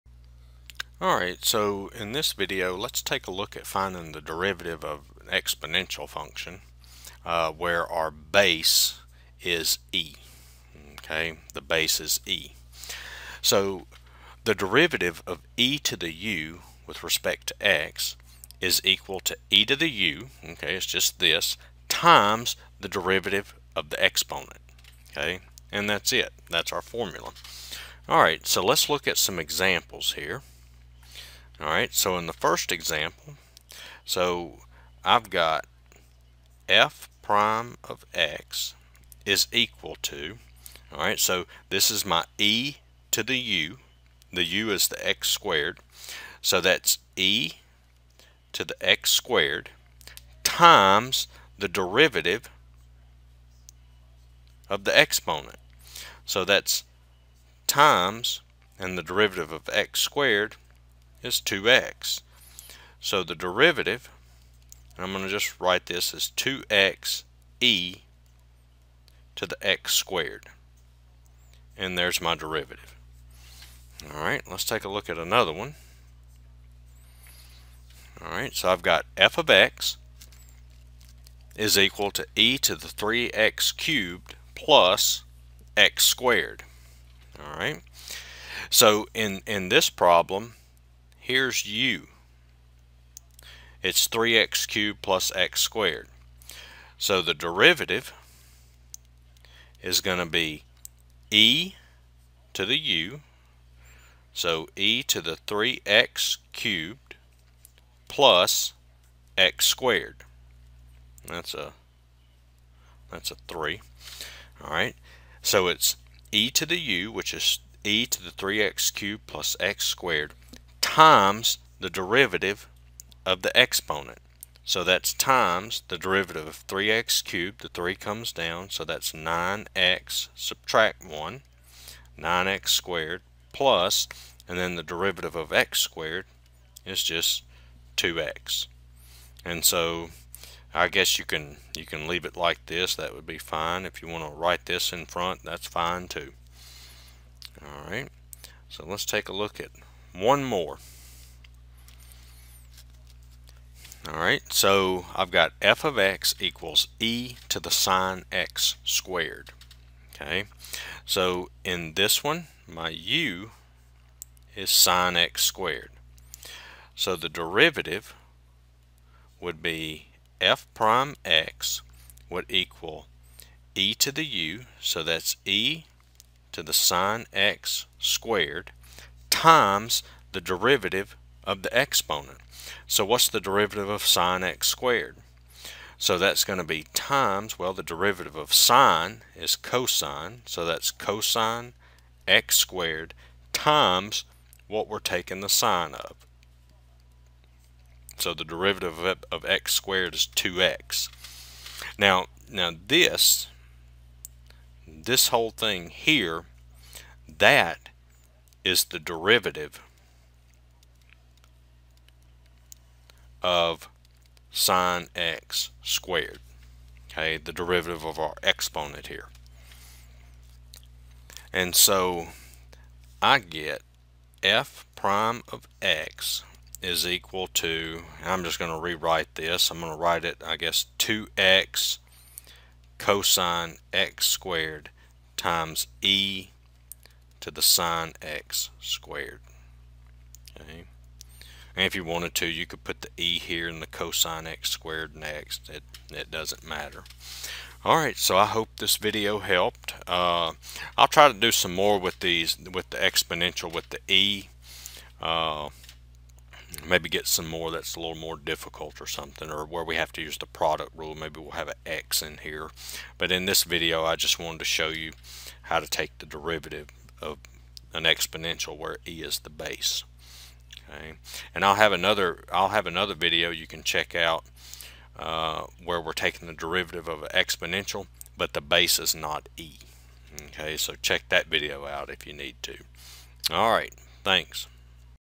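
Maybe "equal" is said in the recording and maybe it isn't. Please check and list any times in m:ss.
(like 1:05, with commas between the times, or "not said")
0:18, 0:39, 1:21, 2:36, 2:52, 3:47.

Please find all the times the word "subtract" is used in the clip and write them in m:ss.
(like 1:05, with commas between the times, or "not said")
2:10.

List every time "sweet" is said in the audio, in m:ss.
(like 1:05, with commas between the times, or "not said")
not said.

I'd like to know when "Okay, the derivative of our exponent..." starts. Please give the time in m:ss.
3:37.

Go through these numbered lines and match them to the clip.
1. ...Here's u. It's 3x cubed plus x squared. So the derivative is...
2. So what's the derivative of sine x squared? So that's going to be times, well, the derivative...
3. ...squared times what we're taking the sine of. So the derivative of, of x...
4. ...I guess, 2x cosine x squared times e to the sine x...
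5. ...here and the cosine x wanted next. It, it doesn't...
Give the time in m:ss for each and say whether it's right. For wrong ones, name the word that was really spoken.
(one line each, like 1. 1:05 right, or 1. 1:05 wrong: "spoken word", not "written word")
1. 1:31 right
2. 3:02 right
3. 3:12 right
4. 3:50 right
5. 4:03 wrong: "squared", not "wanted".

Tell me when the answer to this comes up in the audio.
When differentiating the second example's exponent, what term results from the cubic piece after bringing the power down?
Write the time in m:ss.
2:12.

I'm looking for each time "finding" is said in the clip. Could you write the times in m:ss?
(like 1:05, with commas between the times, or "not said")
0:03.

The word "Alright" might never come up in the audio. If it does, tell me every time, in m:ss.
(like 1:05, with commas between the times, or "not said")
0:01, 0:28, 1:14, 1:18, 1:27, 4:07.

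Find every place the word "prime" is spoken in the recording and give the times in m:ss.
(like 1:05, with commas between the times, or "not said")
0:37, 2:50, 3:44.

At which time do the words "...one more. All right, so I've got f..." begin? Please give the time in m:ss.
2:30.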